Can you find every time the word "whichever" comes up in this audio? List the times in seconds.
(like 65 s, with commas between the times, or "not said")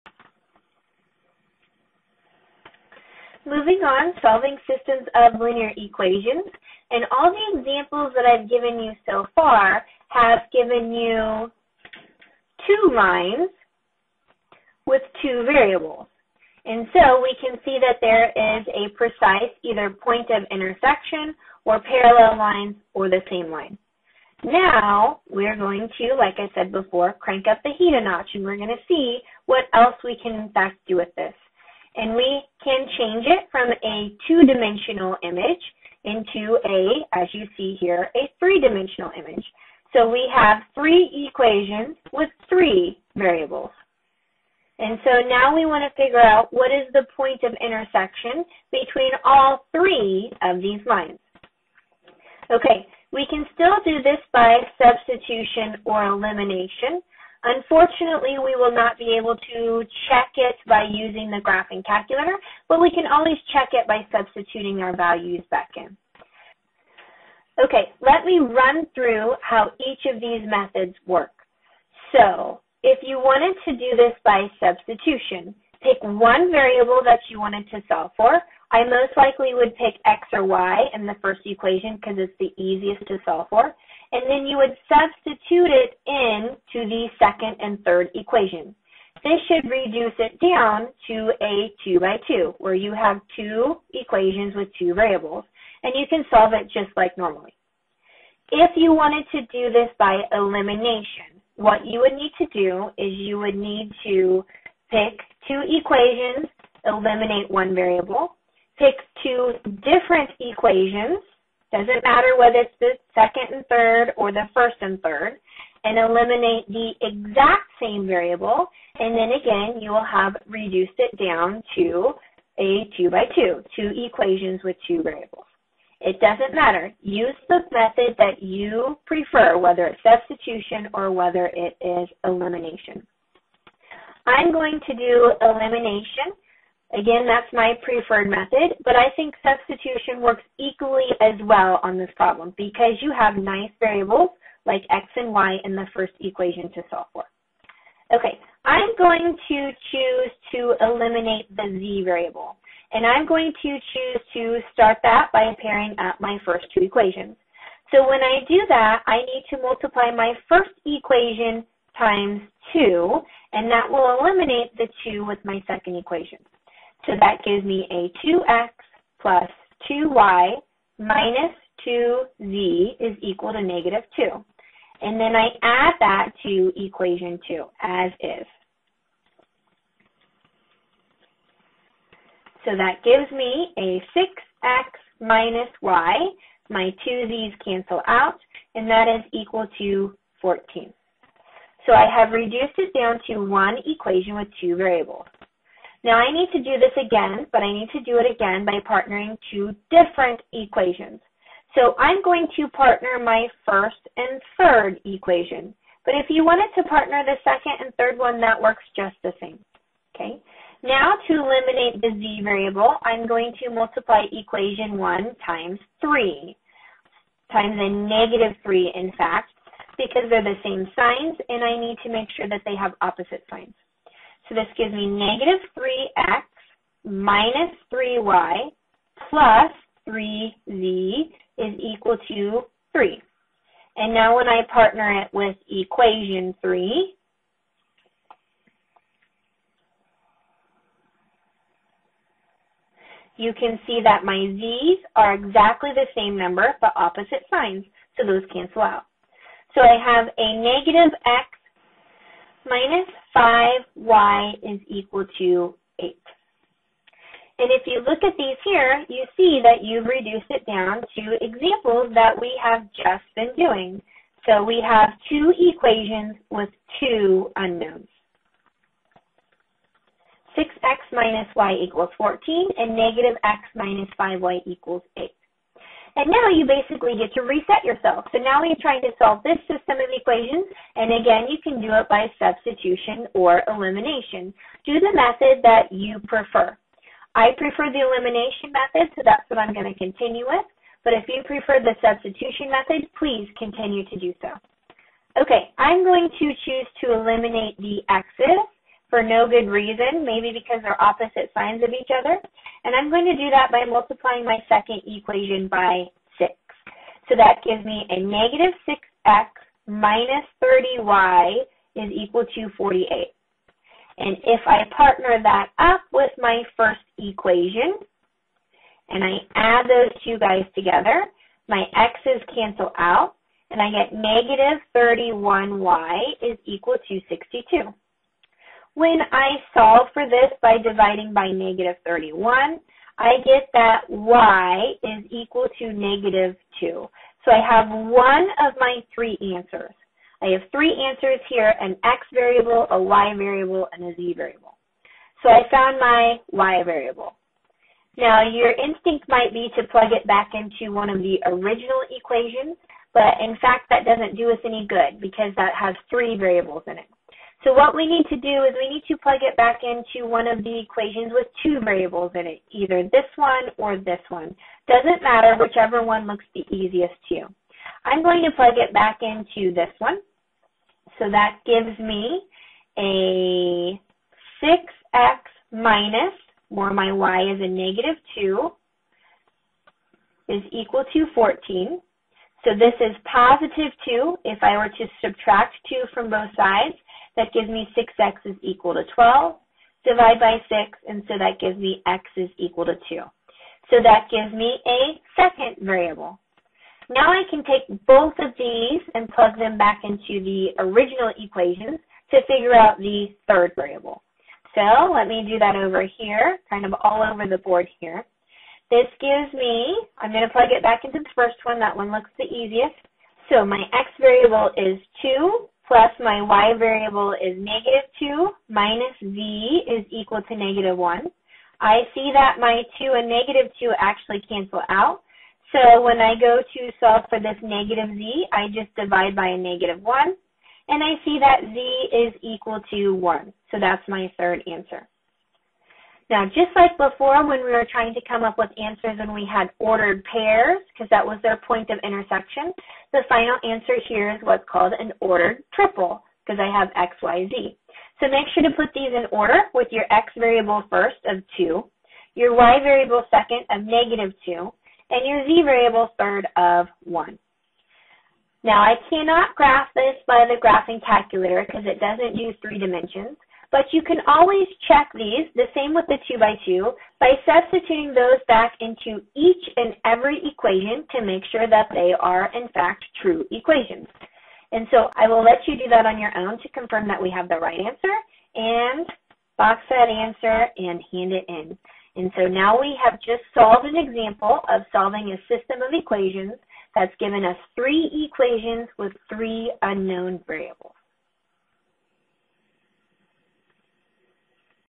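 365 s.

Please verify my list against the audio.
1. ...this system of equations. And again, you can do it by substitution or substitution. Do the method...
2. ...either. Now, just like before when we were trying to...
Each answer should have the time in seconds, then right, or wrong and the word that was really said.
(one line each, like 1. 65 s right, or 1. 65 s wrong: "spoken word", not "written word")
1. 279 s wrong: "elimination", not "substitution"
2. 434 s wrong: "answer", not "either".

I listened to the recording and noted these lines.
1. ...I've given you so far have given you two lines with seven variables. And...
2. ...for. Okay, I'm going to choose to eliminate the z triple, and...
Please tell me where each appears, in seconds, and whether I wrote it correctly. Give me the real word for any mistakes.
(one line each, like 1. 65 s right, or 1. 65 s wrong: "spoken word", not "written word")
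1. 8 s wrong: "two", not "seven"
2. 147 s wrong: "variable", not "triple".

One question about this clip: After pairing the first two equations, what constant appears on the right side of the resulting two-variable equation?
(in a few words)
14.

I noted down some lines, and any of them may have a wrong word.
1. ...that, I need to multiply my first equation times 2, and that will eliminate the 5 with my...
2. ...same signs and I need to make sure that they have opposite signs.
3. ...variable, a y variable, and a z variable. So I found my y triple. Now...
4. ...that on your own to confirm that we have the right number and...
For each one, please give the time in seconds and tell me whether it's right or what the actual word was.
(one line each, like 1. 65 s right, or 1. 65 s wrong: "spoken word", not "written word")
1. 158 s wrong: "2", not "5"
2. 220 s right
3. 342 s wrong: "variable", not "triple"
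4. 475 s wrong: "answer", not "number".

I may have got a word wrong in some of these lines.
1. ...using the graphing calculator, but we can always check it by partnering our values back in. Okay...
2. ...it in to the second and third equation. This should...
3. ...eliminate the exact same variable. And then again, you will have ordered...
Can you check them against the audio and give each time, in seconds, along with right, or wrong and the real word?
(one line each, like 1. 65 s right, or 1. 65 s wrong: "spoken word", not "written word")
1. 60 s wrong: "substituting", not "partnering"
2. 85 s right
3. 115 s wrong: "reduced", not "ordered".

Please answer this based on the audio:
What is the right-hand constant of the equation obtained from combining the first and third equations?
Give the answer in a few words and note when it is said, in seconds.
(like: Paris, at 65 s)
8, at 250 s.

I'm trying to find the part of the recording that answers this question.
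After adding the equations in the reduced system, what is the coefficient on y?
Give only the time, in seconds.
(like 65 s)
324 s.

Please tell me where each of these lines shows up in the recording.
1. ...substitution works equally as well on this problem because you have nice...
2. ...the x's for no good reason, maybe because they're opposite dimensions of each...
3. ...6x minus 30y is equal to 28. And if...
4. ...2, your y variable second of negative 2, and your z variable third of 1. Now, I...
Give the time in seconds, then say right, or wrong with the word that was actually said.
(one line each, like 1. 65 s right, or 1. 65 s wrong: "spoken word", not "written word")
1. 139 s right
2. 297 s wrong: "signs", not "dimensions"
3. 308 s wrong: "48", not "28"
4. 451 s right.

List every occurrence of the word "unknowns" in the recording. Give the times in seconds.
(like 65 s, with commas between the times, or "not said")
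267 s, 489 s.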